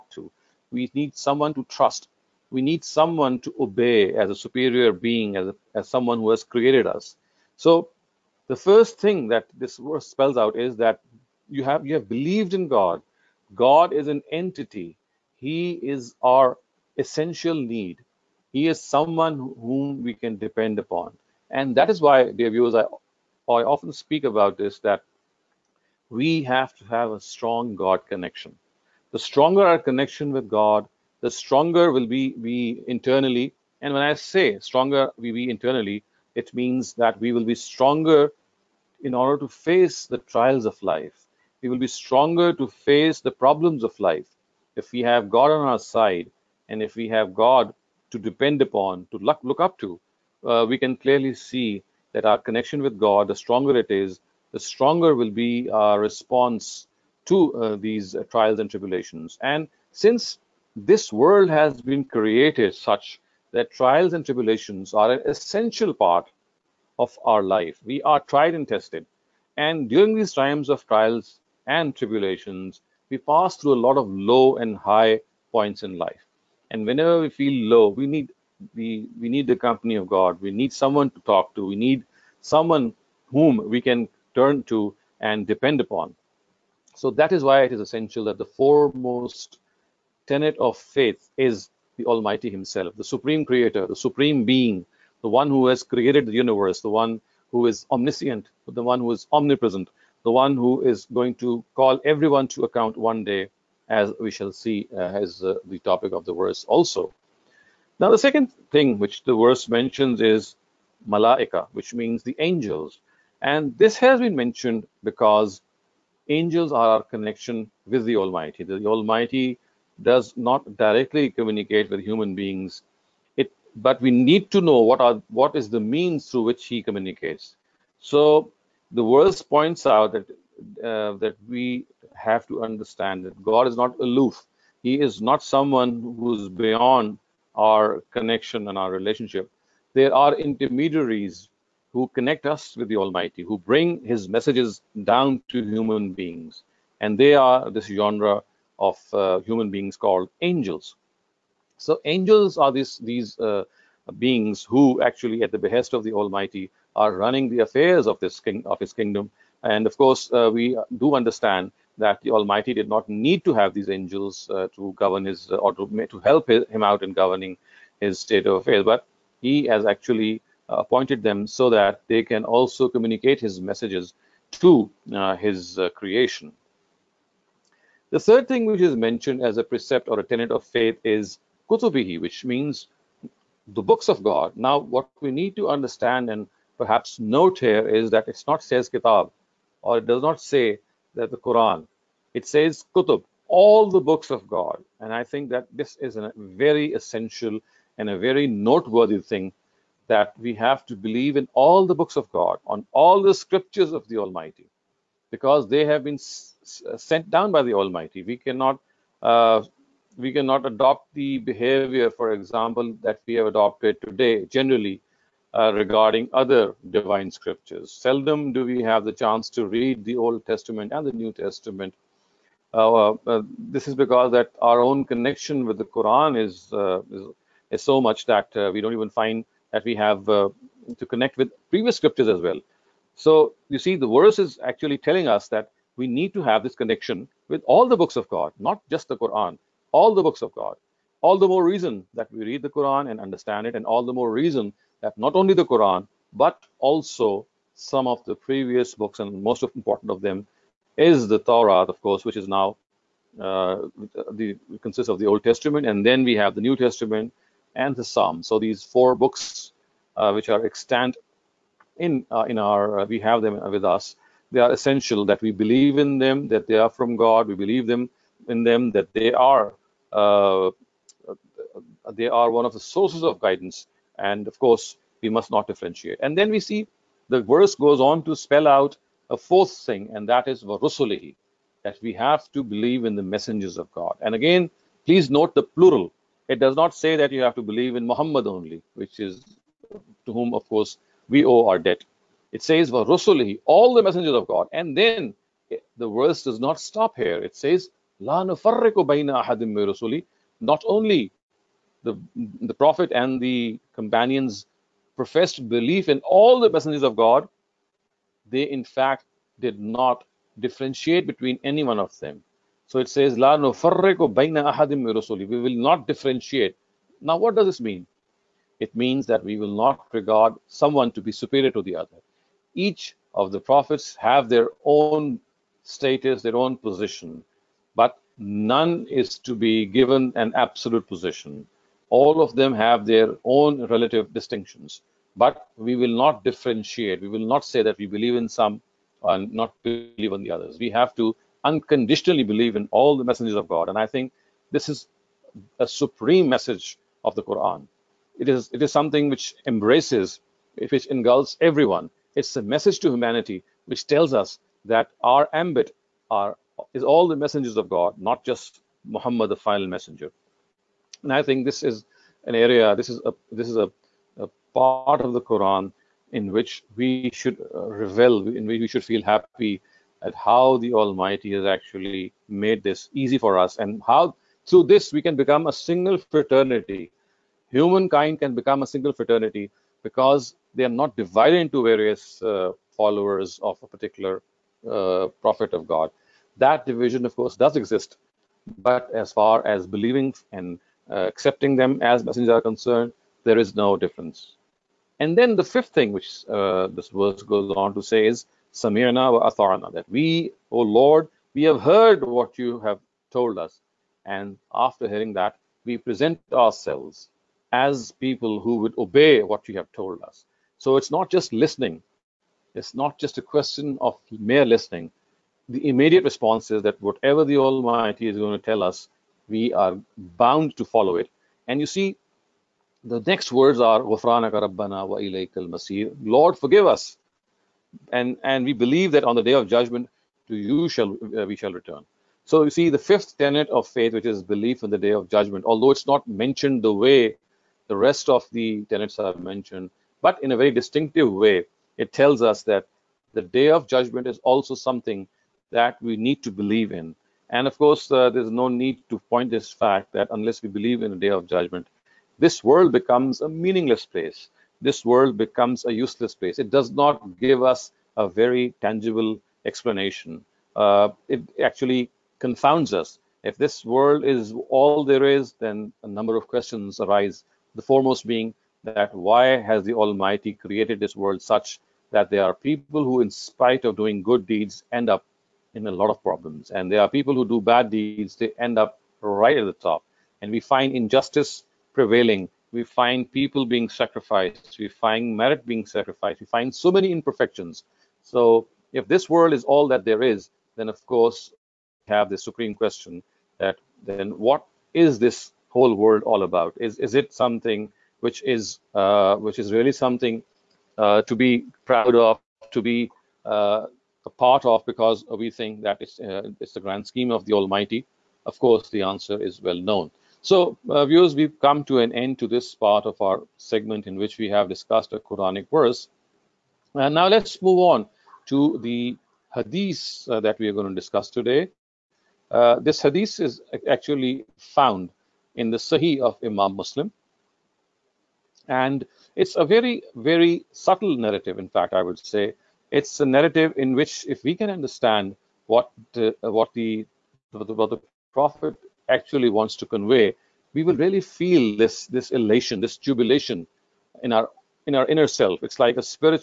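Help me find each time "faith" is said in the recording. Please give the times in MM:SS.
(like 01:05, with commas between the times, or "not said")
01:30, 03:00, 07:13.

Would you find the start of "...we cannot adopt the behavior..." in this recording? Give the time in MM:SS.
03:30.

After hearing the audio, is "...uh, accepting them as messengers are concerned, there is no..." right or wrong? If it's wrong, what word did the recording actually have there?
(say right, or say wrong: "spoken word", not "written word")
right.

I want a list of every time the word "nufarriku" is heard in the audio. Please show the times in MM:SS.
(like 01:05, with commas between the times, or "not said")
04:58, 05:13.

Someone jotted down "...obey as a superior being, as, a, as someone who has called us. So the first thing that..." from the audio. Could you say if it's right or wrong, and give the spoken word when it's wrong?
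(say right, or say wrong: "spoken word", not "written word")
wrong: "created", not "called".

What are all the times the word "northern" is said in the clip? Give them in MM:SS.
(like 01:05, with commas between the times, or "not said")
not said.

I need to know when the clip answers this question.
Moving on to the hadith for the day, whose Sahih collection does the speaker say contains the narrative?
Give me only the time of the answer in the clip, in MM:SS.
08:46.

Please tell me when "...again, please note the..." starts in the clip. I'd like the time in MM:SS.
04:44.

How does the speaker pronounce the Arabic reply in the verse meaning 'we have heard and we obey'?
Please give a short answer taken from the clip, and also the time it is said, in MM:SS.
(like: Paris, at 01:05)
Samirna wa Atharna, at 06:38.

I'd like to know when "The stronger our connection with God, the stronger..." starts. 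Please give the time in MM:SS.
00:29.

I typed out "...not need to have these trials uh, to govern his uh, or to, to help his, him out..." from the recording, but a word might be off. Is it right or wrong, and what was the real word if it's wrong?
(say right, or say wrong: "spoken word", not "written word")
wrong: "angels", not "trials".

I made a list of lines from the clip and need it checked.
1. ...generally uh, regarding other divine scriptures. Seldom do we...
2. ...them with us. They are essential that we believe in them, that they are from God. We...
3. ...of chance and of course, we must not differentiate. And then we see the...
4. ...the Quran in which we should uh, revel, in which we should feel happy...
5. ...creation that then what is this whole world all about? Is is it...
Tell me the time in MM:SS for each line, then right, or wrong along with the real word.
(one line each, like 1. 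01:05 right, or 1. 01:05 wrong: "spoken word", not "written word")
1. 03:34 right
2. 04:23 right
3. 04:33 wrong: "guidance", not "chance"
4. 06:05 right
5. 08:12 wrong: "question", not "creation".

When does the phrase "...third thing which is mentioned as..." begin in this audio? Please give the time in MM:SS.
02:58.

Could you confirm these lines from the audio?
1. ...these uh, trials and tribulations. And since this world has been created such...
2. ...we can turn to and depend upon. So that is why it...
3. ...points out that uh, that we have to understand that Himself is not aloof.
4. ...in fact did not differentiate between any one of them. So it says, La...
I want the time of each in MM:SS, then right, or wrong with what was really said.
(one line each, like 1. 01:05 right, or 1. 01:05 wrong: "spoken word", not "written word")
1. 00:57 right
2. 01:23 right
3. 02:09 wrong: "God", not "Himself"
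4. 05:08 right.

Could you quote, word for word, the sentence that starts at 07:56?
And there are people who do bad deeds, they end up right at the top.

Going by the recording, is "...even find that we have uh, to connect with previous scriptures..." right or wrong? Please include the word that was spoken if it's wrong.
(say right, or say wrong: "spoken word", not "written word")
right.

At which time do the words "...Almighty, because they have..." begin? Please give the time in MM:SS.
03:24.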